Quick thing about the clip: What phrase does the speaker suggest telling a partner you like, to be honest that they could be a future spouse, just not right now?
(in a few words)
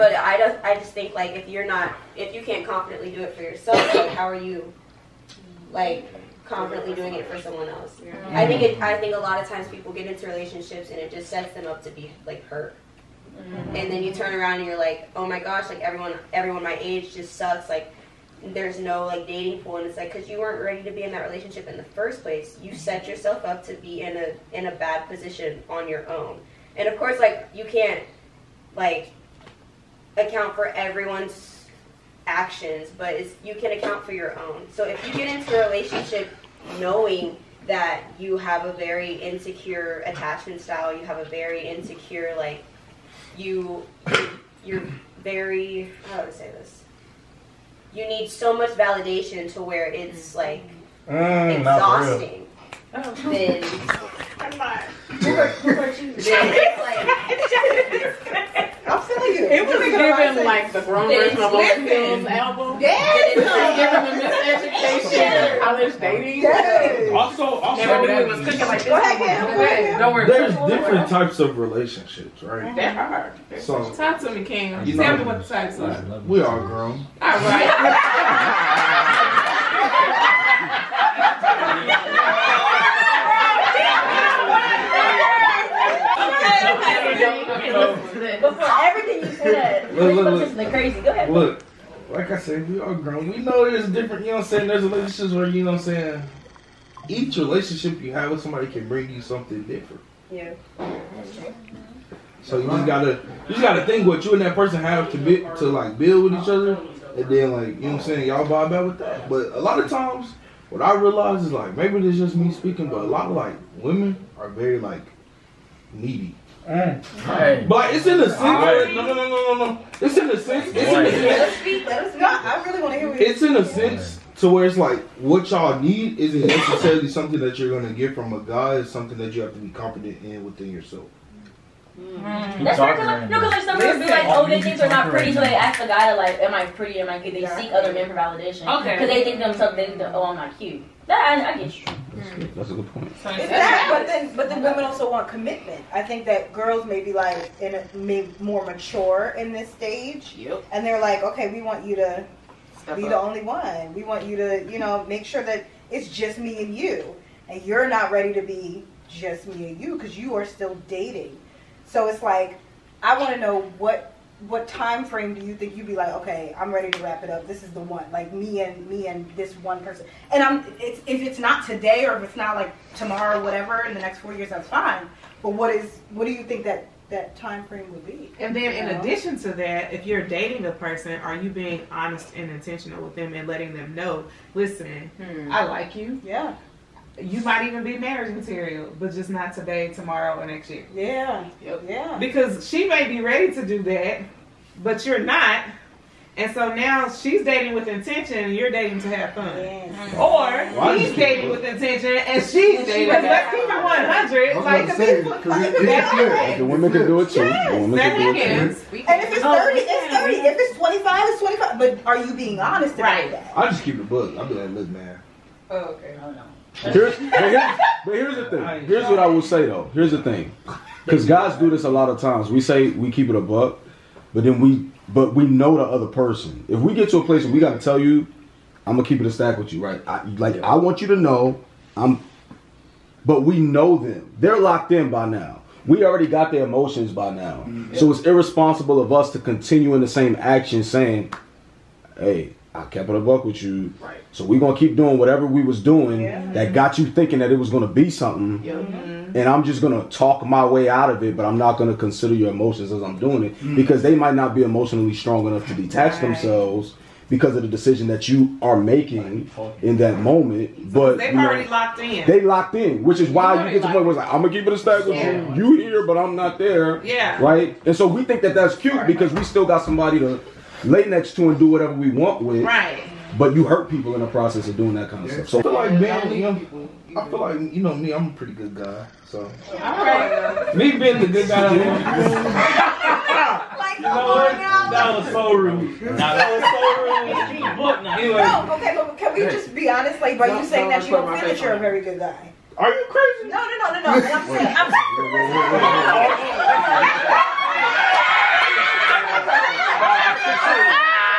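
marriage material.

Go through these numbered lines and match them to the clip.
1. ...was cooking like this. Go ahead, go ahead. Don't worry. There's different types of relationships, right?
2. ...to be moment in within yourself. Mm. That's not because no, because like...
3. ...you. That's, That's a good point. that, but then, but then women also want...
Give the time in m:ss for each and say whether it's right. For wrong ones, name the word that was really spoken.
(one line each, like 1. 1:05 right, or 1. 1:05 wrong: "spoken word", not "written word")
1. 1:08 right
2. 2:09 wrong: "confident", not "moment"
3. 2:21 right.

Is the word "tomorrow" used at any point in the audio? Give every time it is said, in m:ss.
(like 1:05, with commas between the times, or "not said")
2:52, 3:09.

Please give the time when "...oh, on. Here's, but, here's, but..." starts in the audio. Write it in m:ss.
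3:36.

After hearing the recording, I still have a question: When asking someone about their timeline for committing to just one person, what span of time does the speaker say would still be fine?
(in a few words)
4 years.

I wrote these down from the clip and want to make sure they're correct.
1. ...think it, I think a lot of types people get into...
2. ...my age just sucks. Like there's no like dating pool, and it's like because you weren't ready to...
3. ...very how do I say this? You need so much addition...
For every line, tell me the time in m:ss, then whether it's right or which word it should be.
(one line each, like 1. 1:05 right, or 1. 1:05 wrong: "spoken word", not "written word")
1. 0:08 wrong: "times", not "types"
2. 0:16 right
3. 0:45 wrong: "validation", not "addition".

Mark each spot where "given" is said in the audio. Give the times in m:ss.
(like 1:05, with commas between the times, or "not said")
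0:59, 1:05.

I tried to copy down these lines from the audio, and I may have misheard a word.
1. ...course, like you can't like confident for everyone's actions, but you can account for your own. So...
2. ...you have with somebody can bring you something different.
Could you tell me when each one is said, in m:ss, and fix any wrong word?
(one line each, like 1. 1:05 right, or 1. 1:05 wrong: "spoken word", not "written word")
1. 0:26 wrong: "account", not "confident"
2. 1:38 right.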